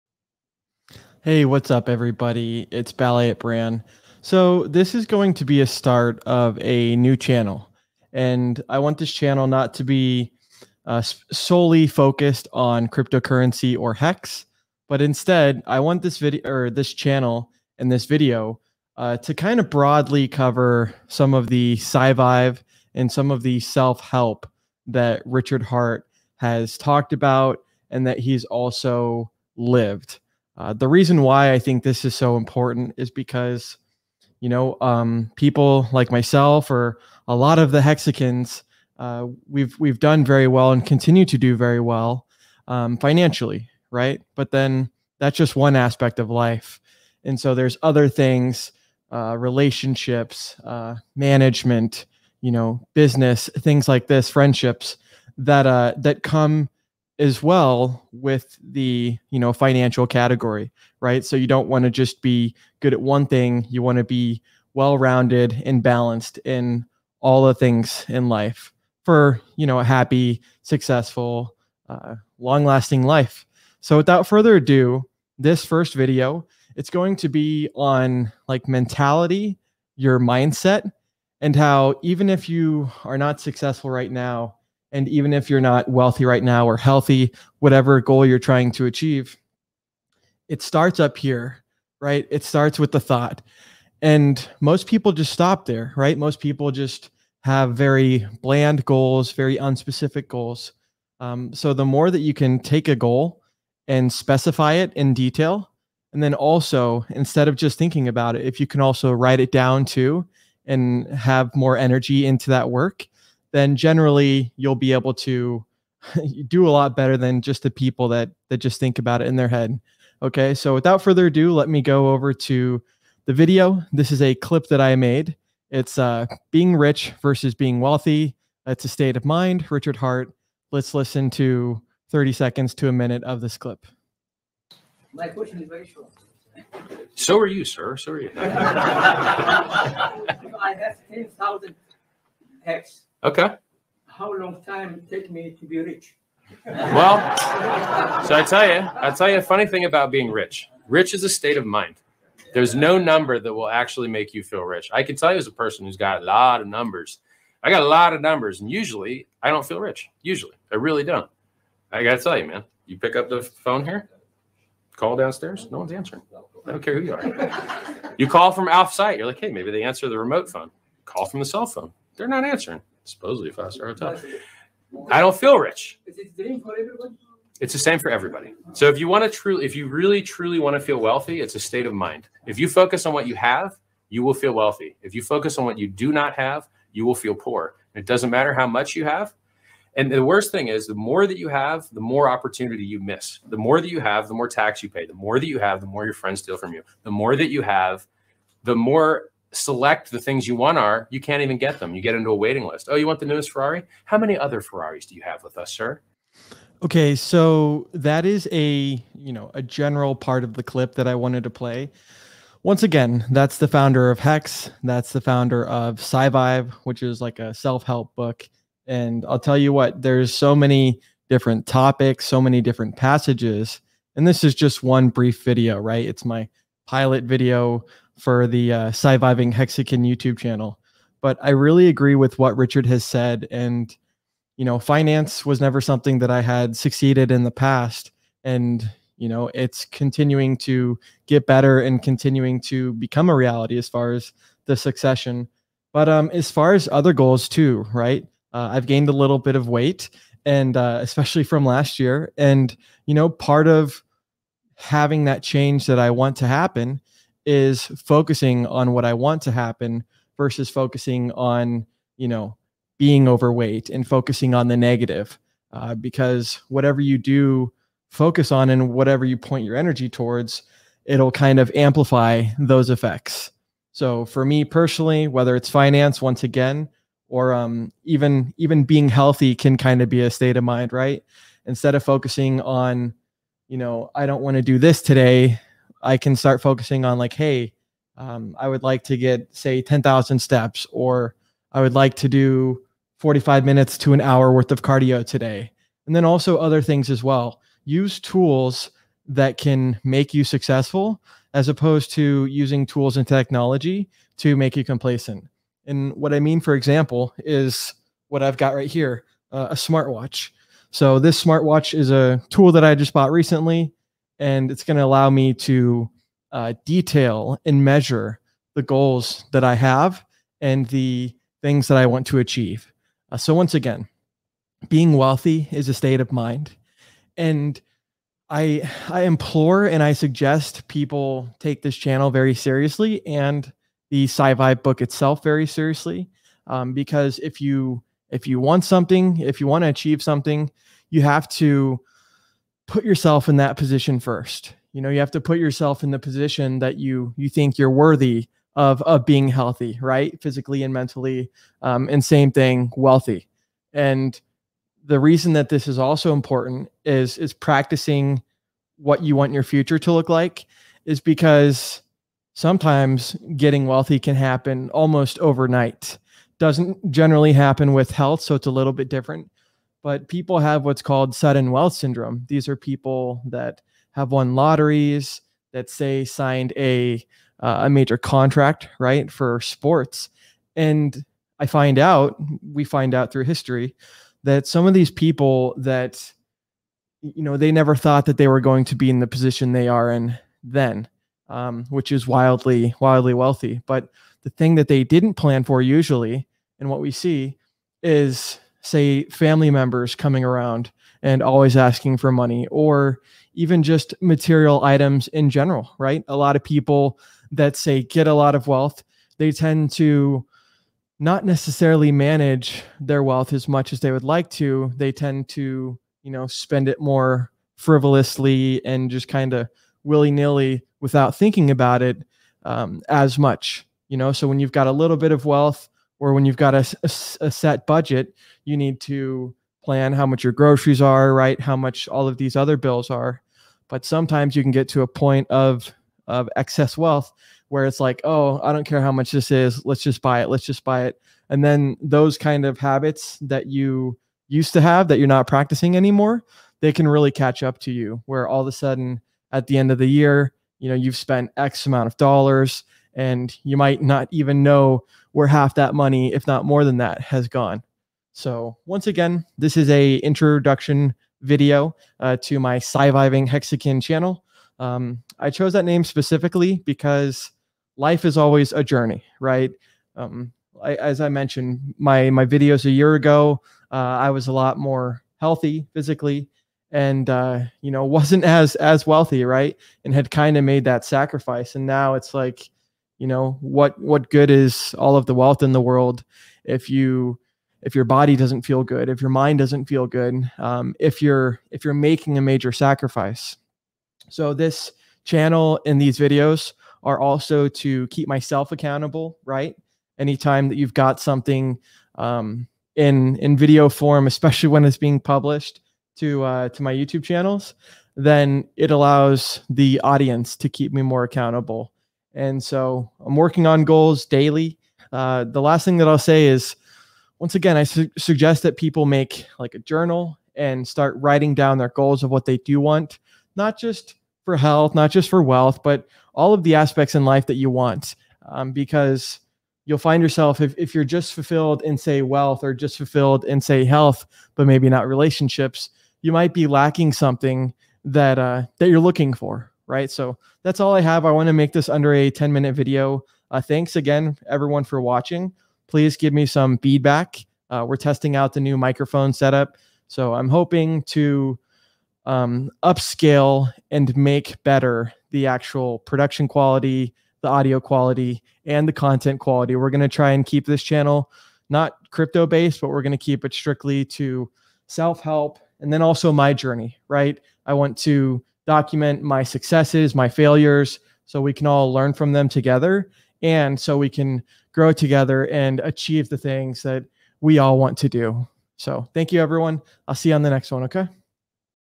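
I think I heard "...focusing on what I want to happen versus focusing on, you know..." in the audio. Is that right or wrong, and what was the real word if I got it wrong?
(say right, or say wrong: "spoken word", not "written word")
right.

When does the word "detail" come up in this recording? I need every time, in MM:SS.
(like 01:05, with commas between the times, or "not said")
01:45, 05:16.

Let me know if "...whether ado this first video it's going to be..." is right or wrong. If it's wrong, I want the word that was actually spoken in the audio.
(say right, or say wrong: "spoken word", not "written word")
wrong: "further", not "whether".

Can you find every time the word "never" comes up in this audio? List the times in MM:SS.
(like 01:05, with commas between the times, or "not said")
03:55, 06:27.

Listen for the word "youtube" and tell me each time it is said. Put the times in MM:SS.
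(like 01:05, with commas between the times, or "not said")
03:50, 08:26.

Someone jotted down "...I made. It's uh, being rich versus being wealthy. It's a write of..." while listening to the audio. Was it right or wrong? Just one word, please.
wrong.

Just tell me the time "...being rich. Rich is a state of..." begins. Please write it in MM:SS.
02:30.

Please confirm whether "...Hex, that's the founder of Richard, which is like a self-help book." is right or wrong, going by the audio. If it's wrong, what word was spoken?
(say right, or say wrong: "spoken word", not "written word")
wrong: "SciVive", not "Richard".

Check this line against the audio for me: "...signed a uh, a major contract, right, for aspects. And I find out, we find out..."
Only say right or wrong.
wrong.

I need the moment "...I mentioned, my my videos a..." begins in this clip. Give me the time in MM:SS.
07:51.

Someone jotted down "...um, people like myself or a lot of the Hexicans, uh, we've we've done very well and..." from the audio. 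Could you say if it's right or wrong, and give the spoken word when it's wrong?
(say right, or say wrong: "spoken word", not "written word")
right.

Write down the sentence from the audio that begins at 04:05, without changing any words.
But um, as far as other goals too, right?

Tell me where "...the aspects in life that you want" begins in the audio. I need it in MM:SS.
08:46.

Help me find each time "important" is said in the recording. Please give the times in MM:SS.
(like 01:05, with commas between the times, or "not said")
00:32, 05:56.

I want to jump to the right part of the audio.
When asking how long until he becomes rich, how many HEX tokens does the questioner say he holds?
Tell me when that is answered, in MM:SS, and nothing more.
02:21.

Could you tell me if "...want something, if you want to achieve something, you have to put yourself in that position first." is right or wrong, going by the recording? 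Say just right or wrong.
right.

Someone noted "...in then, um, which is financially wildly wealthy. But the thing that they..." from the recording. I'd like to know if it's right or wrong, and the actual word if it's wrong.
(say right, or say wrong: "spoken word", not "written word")
wrong: "wildly", not "financially".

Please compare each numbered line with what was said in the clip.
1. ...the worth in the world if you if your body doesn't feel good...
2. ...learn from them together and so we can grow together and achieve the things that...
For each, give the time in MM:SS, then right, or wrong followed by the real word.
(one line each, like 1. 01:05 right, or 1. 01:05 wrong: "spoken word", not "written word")
1. 08:05 wrong: "wealth", not "worth"
2. 09:31 right.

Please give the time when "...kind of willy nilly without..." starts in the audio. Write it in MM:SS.
06:59.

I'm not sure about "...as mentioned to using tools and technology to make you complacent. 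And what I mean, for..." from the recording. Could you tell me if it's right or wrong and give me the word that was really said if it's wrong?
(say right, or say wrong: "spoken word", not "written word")
wrong: "opposed", not "mentioned".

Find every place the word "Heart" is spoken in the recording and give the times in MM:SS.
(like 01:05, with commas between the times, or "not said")
00:25, 02:09.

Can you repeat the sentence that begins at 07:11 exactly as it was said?
How much all of these other bills are.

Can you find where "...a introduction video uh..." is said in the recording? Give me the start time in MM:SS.
07:39.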